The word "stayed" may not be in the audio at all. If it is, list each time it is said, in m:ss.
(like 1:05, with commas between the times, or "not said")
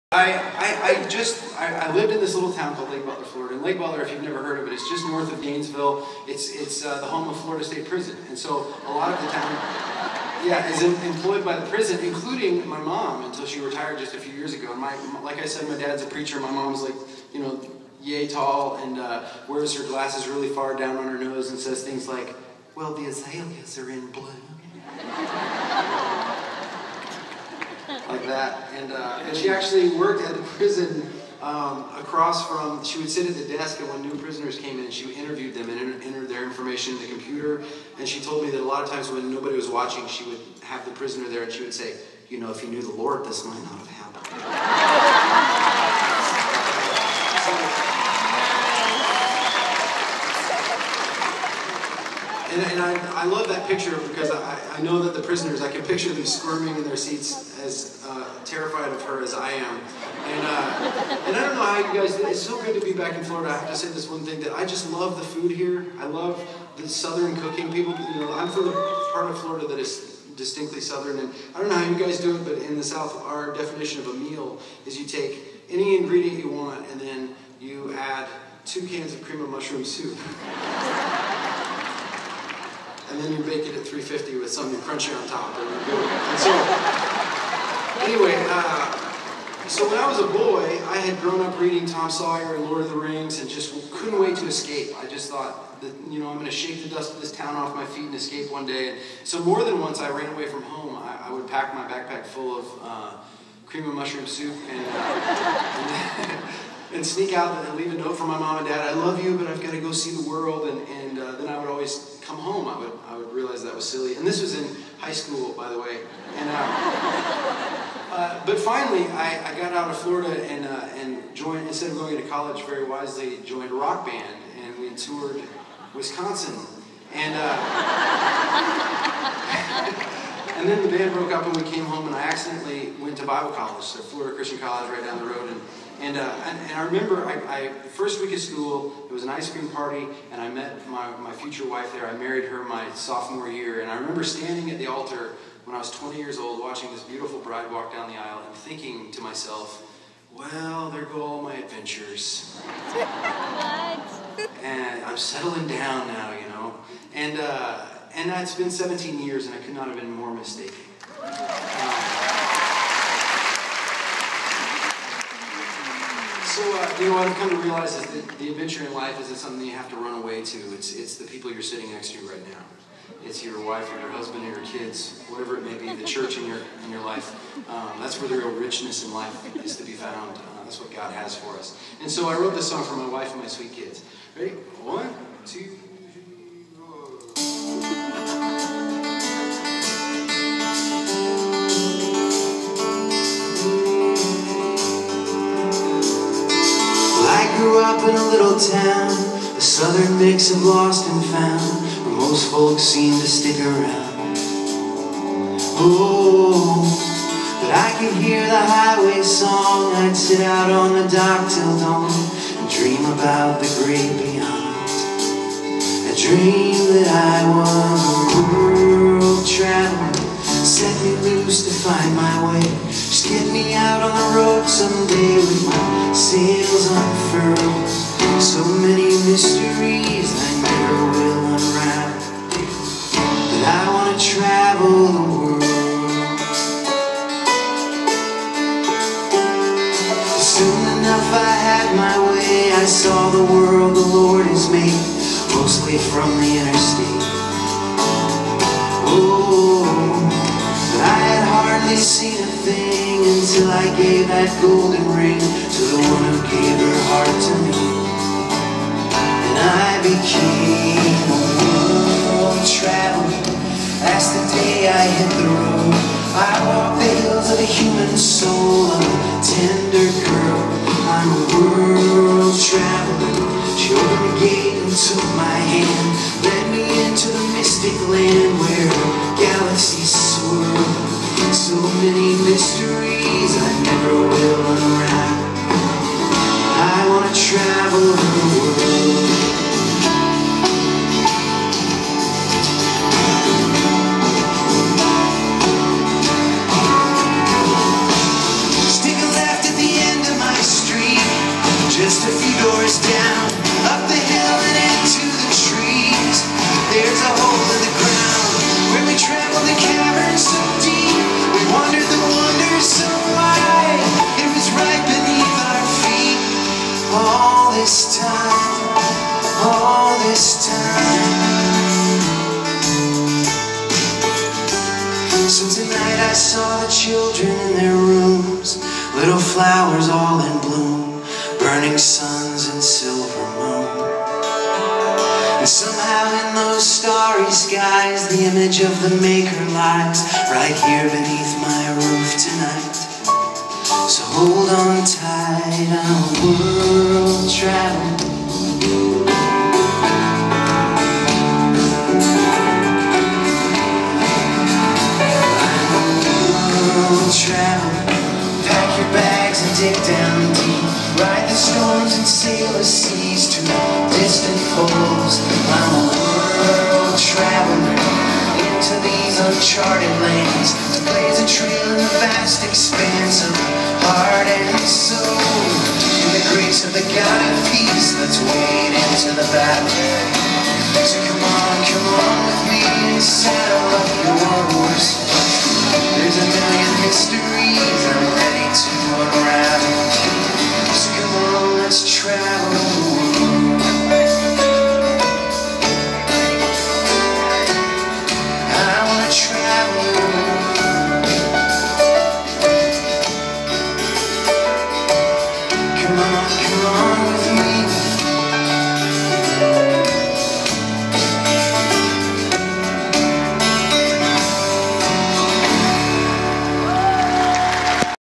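not said.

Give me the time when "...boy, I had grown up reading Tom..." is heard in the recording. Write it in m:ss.
1:30.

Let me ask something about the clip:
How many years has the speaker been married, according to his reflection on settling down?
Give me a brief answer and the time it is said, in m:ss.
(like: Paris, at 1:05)
17, at 2:38.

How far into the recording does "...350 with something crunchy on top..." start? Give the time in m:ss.
1:23.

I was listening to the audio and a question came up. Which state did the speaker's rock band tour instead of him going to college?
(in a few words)
Wisconsin.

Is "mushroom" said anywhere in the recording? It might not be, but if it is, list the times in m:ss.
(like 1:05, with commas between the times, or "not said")
1:19, 1:43.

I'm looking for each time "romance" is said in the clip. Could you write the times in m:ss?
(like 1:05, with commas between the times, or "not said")
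not said.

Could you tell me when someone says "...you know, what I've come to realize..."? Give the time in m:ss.
2:46.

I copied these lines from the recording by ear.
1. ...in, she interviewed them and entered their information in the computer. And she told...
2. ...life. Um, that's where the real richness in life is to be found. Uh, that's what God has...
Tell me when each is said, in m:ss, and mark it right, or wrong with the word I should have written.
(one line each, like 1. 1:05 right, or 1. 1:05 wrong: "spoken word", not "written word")
1. 0:34 right
2. 2:57 right.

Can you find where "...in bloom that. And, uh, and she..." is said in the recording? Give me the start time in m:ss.
0:23.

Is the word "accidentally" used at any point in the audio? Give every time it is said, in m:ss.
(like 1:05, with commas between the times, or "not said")
2:12.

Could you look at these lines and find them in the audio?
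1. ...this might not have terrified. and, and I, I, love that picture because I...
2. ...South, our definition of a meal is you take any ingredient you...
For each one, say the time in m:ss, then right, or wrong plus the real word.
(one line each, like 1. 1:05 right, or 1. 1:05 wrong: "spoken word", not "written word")
1. 0:43 wrong: "happened", not "terrified"
2. 1:12 right.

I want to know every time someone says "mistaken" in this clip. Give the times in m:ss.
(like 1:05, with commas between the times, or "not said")
2:40.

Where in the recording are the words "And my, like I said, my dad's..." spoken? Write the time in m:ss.
0:14.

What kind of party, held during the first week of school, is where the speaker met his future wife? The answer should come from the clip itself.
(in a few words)
Ice cream party.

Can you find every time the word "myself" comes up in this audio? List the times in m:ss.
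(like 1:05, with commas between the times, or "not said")
2:29.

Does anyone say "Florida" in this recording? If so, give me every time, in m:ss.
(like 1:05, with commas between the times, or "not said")
0:03, 0:07, 1:03, 1:09, 1:59, 2:14.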